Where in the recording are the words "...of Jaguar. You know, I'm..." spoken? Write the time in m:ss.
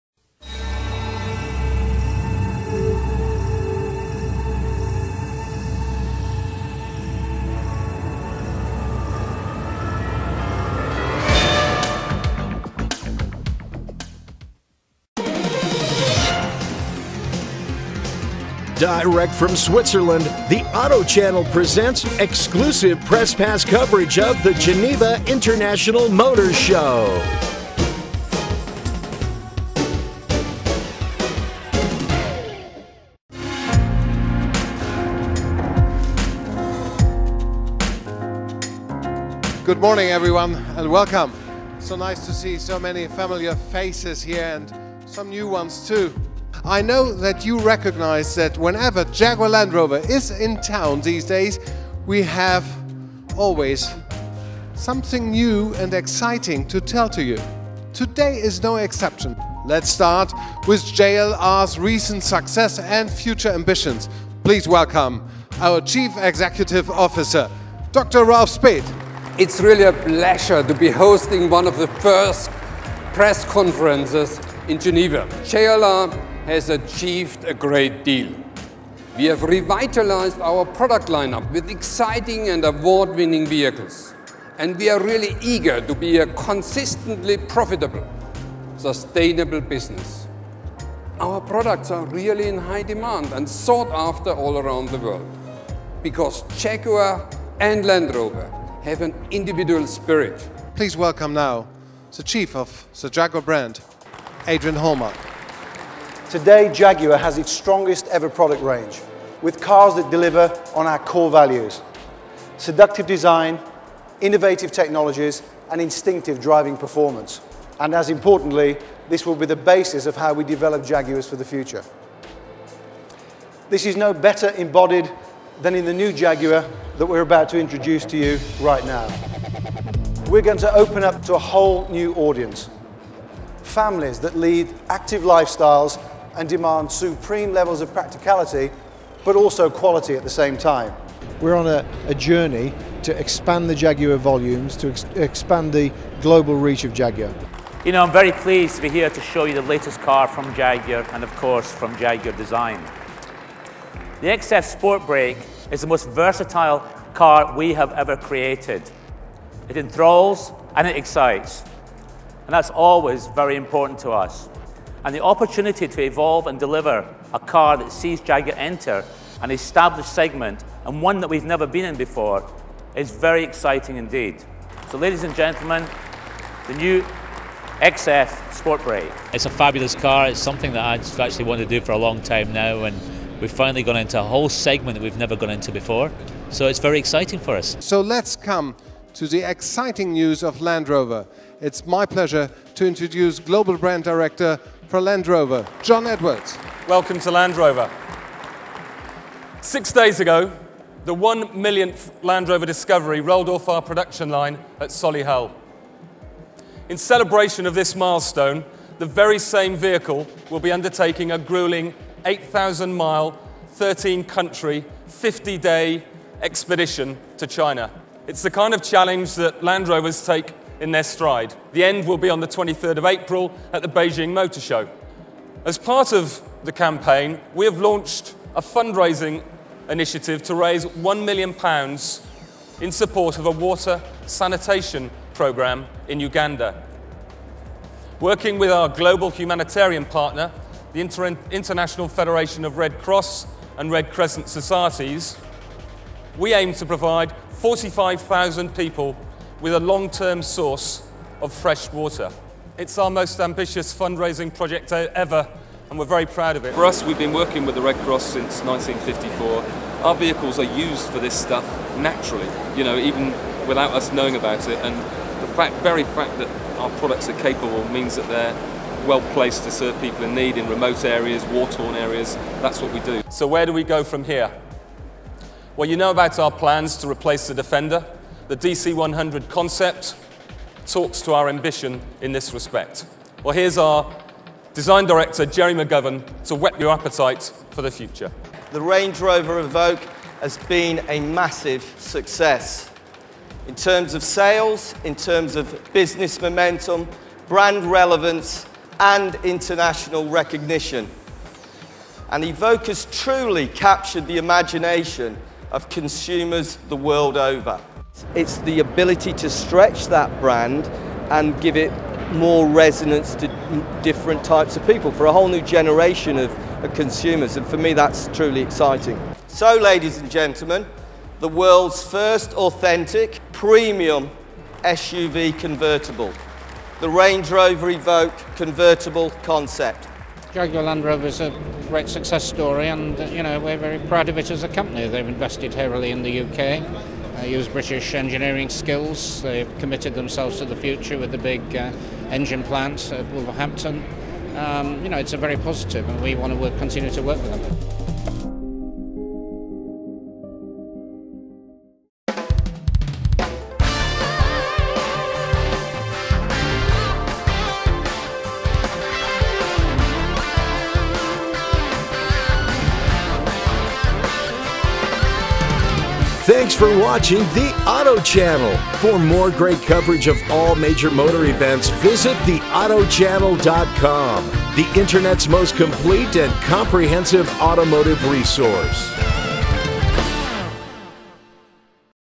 2:26.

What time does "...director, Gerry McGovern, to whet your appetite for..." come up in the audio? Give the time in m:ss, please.
4:45.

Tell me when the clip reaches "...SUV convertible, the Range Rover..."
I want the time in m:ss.
5:24.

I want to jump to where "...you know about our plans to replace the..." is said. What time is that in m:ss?
4:35.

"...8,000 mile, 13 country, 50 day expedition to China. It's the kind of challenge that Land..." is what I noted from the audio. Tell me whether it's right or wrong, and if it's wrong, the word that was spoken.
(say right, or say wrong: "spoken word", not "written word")
right.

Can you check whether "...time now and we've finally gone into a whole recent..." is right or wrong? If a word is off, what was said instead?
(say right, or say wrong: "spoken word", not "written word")
wrong: "segment", not "recent".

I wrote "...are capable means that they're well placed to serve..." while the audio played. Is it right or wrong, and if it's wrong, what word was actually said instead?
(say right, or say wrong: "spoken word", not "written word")
right.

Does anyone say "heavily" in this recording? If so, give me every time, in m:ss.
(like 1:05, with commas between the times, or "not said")
5:35.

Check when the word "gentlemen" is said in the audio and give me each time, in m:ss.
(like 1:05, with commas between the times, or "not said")
2:55, 5:20.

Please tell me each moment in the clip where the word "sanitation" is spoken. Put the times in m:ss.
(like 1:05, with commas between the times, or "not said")
3:54.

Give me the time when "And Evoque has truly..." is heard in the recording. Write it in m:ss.
5:02.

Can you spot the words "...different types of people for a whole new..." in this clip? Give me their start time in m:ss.
5:14.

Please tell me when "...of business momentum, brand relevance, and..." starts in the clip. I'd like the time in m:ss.
4:55.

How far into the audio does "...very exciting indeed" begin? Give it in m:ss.
2:53.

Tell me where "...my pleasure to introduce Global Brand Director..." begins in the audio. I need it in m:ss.
3:11.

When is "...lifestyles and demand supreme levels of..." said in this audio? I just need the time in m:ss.
2:15.